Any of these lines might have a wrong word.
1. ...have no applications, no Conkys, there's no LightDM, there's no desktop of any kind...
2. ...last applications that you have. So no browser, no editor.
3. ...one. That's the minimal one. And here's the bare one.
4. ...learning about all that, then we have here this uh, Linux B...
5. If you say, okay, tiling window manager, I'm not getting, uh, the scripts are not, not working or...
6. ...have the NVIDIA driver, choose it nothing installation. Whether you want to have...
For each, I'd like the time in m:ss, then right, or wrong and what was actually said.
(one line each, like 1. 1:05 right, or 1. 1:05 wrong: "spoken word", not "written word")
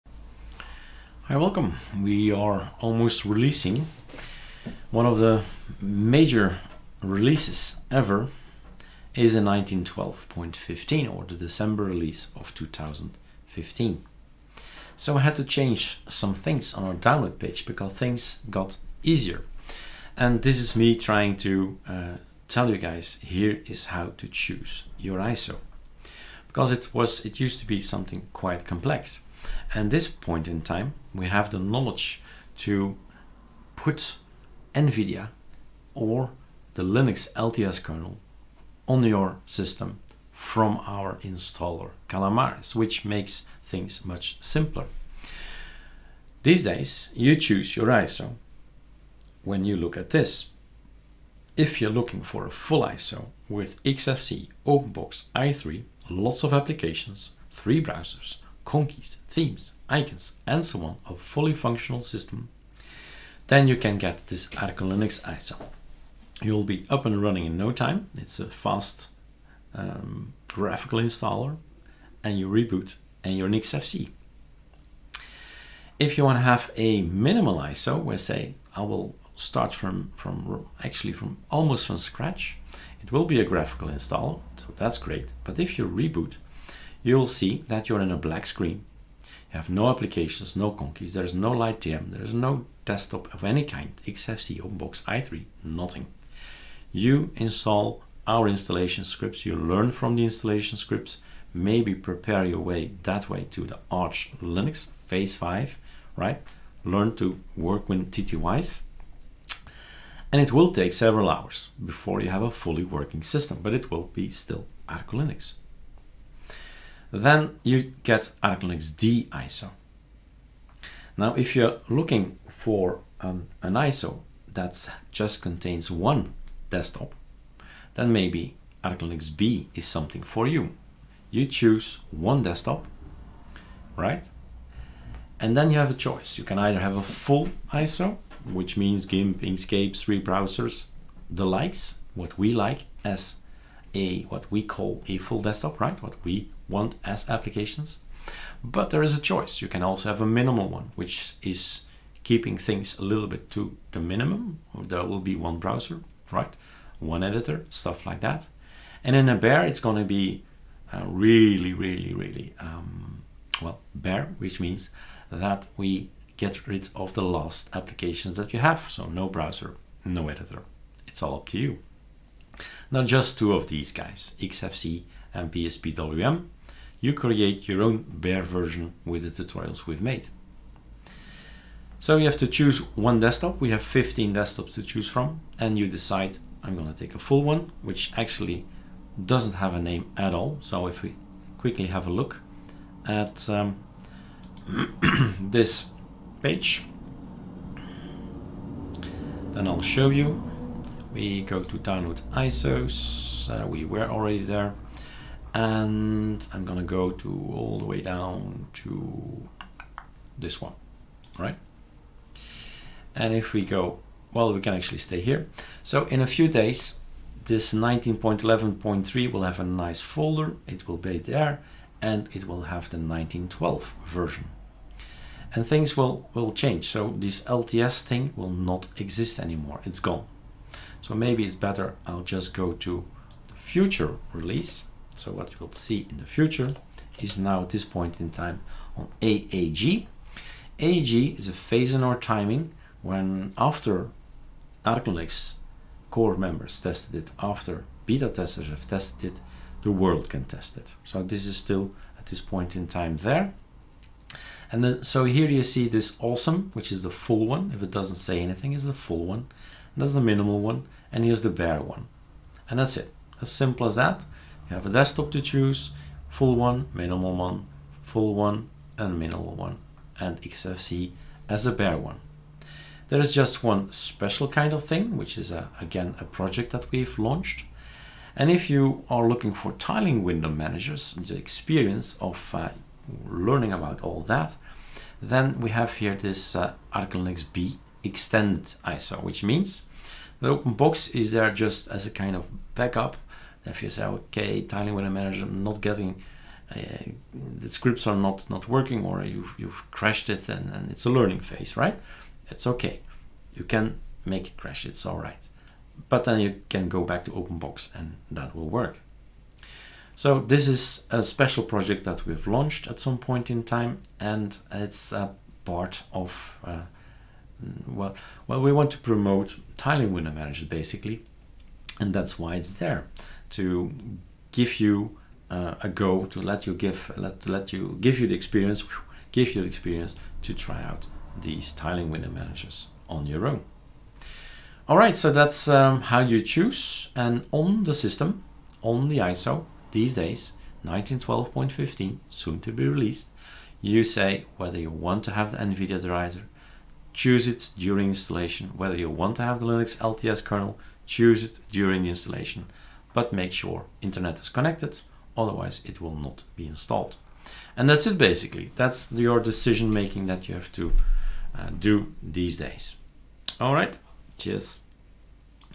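1. 1:29 right
2. 2:47 right
3. 4:19 right
4. 4:43 right
5. 4:53 right
6. 5:45 wrong: "during", not "nothing".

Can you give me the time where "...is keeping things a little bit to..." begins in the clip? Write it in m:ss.
2:31.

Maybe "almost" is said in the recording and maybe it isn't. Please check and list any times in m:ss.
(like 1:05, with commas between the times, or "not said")
0:02, 1:21.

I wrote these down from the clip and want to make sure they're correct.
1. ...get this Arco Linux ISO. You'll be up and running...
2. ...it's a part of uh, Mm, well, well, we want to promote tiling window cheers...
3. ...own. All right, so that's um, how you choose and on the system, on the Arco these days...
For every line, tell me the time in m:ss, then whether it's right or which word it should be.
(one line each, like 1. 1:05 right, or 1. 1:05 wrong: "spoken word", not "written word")
1. 1:03 right
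2. 5:14 wrong: "managers", not "cheers"
3. 5:33 wrong: "ISO", not "Arco".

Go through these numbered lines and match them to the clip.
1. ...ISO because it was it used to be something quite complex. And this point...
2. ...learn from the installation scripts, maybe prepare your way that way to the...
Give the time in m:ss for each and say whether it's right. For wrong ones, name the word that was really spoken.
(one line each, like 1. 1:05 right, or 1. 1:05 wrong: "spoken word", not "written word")
1. 0:25 right
2. 1:39 right.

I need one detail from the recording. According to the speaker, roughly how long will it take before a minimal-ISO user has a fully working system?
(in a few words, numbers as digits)
several hours.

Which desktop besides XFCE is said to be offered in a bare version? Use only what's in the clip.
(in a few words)
PSPWM.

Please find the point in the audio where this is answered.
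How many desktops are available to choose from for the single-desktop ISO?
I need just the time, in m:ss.
3:03.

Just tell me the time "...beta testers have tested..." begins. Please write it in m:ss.
4:08.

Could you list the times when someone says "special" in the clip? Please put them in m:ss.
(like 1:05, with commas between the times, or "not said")
4:33, 5:11.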